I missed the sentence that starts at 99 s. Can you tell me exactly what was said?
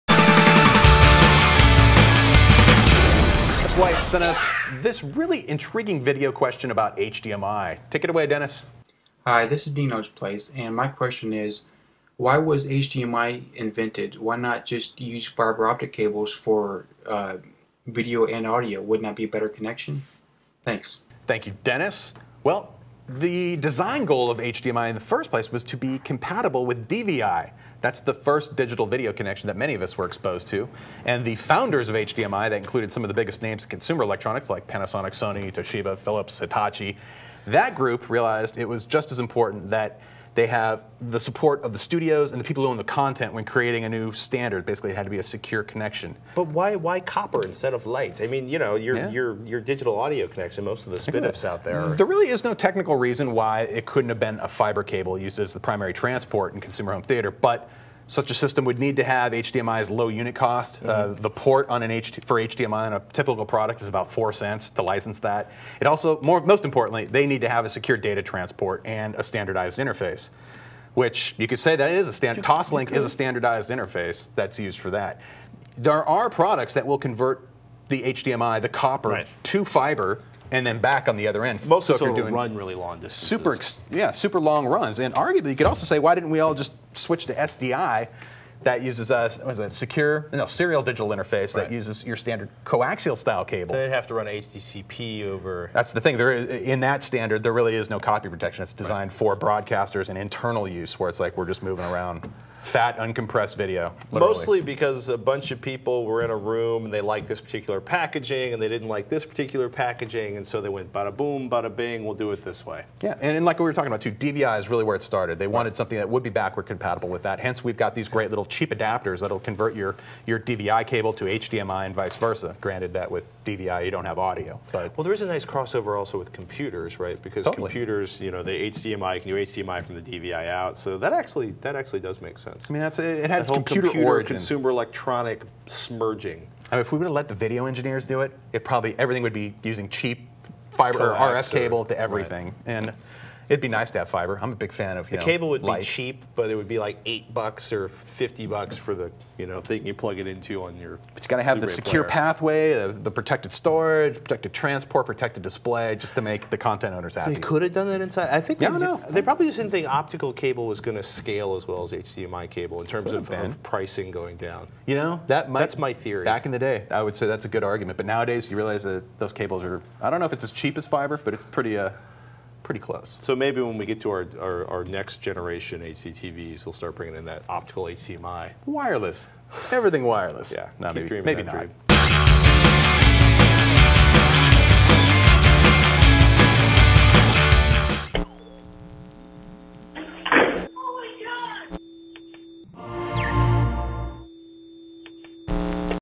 for broadcasters and internal use, where it's like we're just moving around fat, uncompressed video.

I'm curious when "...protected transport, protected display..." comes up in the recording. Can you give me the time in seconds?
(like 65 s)
154 s.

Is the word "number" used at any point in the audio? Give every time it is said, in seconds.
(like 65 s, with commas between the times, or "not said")
not said.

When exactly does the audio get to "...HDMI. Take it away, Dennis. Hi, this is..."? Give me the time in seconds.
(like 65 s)
6 s.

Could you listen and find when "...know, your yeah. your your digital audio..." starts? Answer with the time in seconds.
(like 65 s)
48 s.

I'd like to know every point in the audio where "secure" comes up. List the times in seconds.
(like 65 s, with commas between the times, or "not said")
45 s, 67 s, 89 s, 151 s.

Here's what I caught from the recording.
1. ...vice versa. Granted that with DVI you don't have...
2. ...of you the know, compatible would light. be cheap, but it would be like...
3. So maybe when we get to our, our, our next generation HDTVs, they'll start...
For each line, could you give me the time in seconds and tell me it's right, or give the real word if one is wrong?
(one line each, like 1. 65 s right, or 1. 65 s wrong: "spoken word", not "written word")
1. 121 s right
2. 144 s wrong: "cable", not "compatible"
3. 173 s right.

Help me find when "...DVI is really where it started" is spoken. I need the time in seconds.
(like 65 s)
114 s.